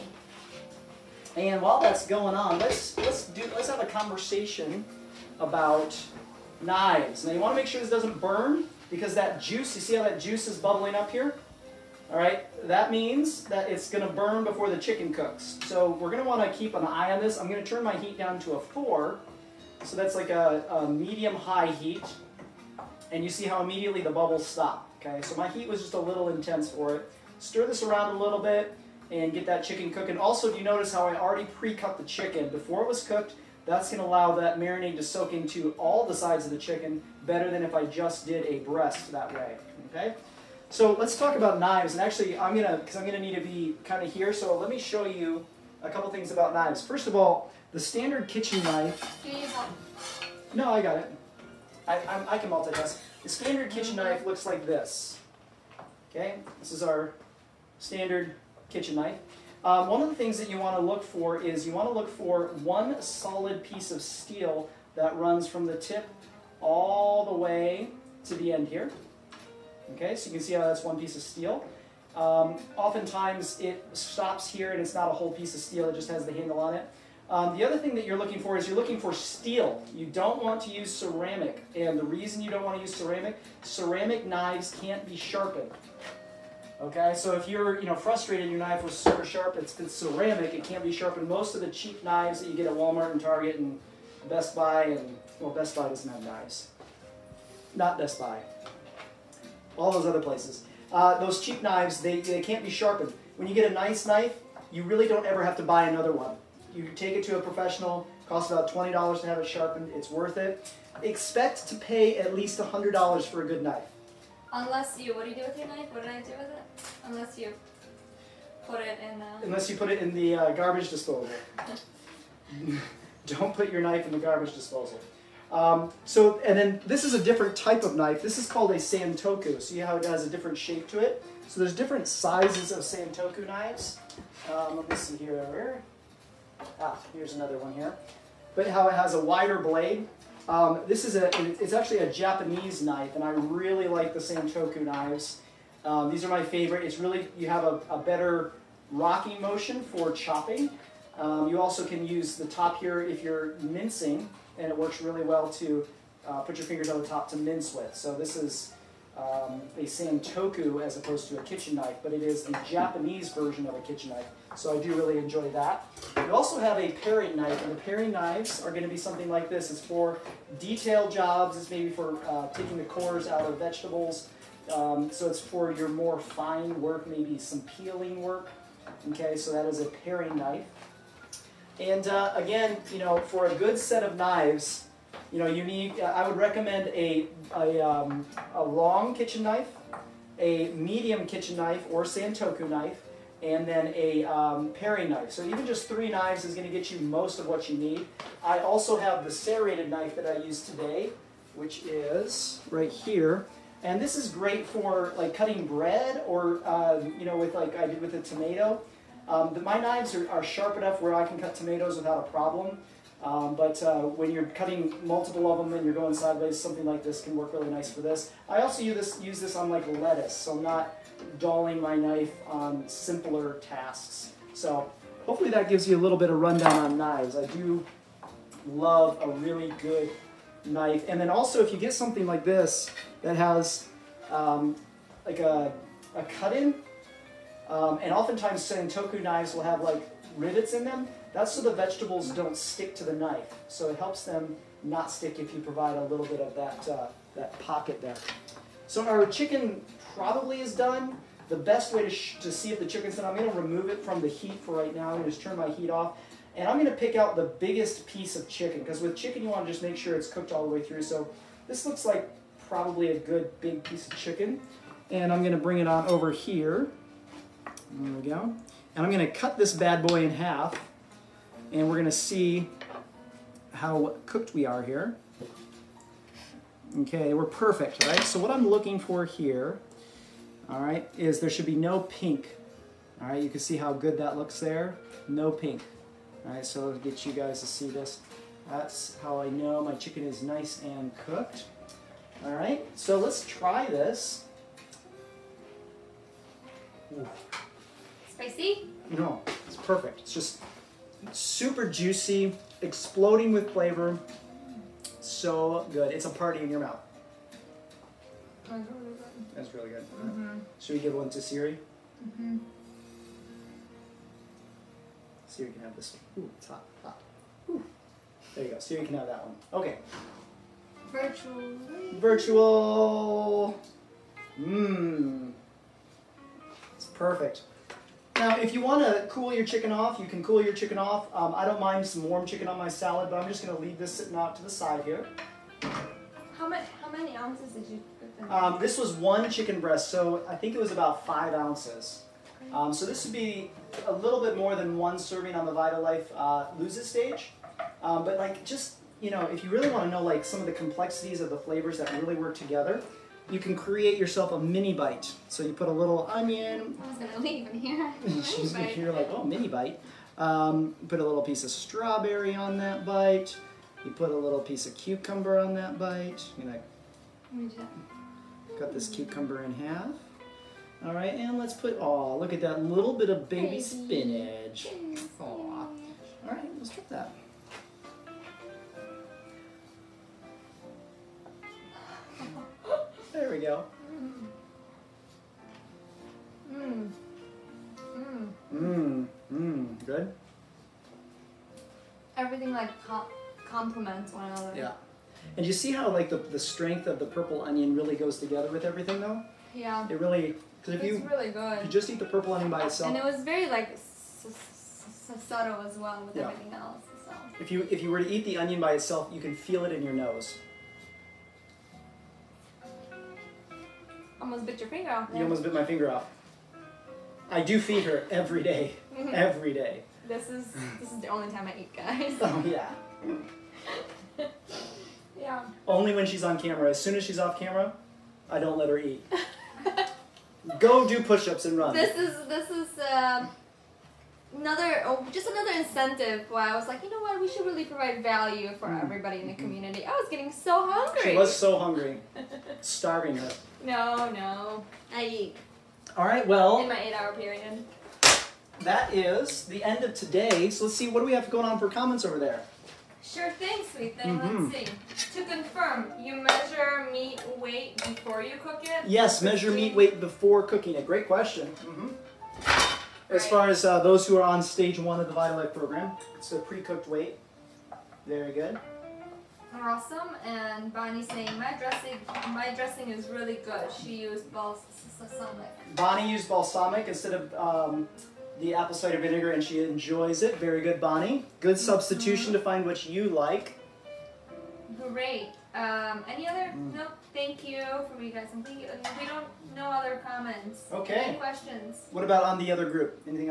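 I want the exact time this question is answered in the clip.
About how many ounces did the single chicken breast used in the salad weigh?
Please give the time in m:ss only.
5:41.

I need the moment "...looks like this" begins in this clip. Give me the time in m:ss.
0:54.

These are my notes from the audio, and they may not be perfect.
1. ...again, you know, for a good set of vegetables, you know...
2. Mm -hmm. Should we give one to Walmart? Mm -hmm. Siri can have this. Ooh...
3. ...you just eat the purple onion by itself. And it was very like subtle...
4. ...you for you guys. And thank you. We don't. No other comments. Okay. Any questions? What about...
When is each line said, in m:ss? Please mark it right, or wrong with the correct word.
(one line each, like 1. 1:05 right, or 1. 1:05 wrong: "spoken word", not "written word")
1. 3:02 wrong: "knives", not "vegetables"
2. 5:10 wrong: "Siri", not "Walmart"
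3. 6:41 right
4. 8:07 right.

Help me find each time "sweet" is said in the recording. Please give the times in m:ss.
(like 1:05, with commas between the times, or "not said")
7:33.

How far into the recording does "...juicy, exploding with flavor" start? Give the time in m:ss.
5:01.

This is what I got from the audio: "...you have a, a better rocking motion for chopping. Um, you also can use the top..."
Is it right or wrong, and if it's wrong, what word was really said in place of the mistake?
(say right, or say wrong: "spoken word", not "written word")
right.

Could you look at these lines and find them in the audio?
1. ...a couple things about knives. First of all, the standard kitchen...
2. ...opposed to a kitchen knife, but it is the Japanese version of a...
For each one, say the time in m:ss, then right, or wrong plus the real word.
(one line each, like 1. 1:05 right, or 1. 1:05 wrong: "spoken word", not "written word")
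1. 0:45 right
2. 2:40 right.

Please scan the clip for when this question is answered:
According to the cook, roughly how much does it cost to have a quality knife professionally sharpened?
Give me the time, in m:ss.
1:48.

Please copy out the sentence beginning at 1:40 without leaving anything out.
Uh, those cheap knives, they, they can't be sharpened.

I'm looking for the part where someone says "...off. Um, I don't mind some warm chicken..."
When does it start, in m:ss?
5:30.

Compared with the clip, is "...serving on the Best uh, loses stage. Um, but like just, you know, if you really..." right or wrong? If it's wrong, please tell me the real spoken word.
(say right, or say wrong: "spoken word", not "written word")
wrong: "VitaLife", not "Best".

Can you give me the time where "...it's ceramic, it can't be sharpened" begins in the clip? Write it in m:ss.
1:29.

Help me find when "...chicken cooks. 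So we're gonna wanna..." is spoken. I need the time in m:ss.
0:14.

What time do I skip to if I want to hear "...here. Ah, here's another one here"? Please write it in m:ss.
2:15.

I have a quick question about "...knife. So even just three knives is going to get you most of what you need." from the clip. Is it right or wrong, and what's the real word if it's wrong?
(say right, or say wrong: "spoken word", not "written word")
right.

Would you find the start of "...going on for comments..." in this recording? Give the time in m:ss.
7:31.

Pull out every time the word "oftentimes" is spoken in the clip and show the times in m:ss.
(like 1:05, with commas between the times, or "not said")
1:12, 3:58.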